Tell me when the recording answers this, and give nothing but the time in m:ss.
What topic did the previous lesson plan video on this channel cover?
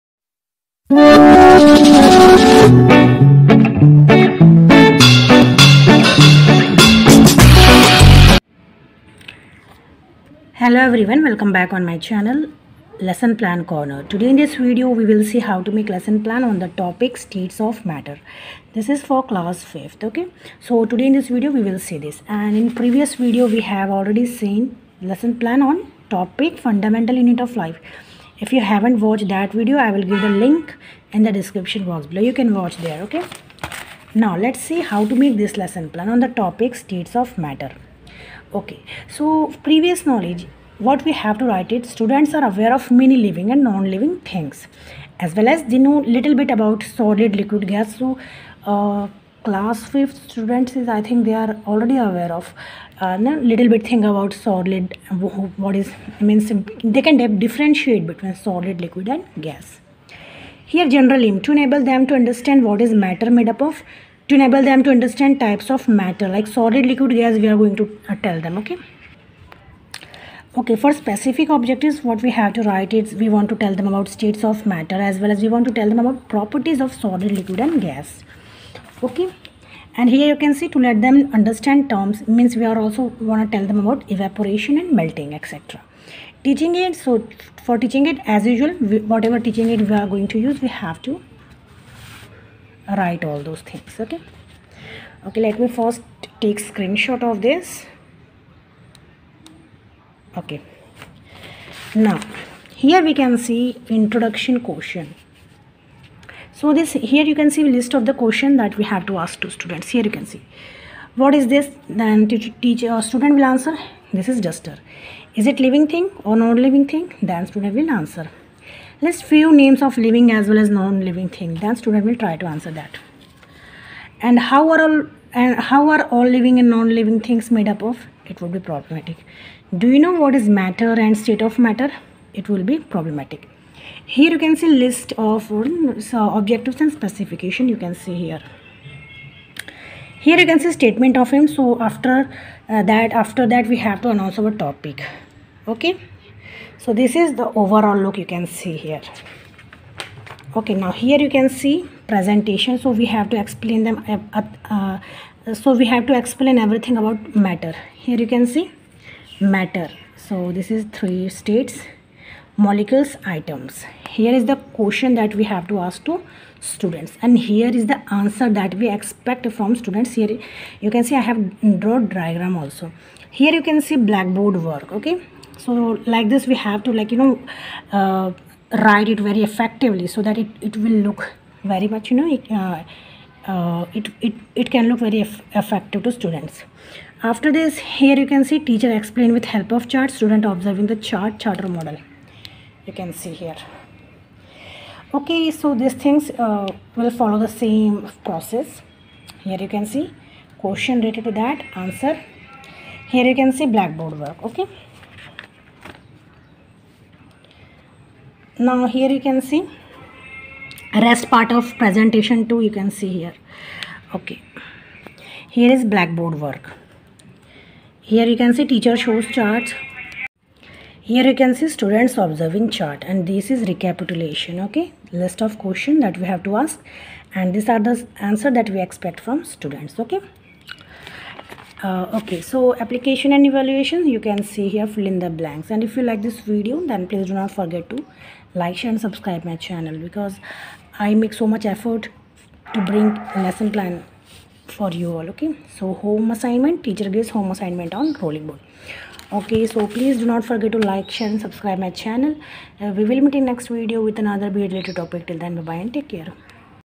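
0:26.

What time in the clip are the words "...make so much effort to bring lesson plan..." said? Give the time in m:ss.
4:01.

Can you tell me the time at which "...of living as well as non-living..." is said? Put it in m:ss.
1:59.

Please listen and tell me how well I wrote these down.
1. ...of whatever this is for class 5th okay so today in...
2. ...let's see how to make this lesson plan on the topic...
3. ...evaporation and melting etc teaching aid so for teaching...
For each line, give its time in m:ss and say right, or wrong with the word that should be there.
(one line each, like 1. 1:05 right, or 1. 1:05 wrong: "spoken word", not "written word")
1. 0:17 wrong: "matter", not "whatever"
2. 0:34 right
3. 1:24 right.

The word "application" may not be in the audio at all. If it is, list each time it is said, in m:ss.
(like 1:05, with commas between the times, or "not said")
3:52.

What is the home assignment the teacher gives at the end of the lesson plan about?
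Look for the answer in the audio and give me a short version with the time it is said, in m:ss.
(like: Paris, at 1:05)
Rolling ball, at 4:08.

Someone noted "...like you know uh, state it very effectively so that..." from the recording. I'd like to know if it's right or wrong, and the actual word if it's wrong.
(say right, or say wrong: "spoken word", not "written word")
wrong: "write", not "state".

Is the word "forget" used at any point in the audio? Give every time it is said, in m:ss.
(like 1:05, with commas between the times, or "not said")
3:57, 4:10.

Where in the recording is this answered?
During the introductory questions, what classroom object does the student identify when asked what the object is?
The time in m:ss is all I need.
1:54.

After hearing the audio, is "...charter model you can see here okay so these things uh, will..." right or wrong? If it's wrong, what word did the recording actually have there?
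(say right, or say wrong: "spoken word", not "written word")
right.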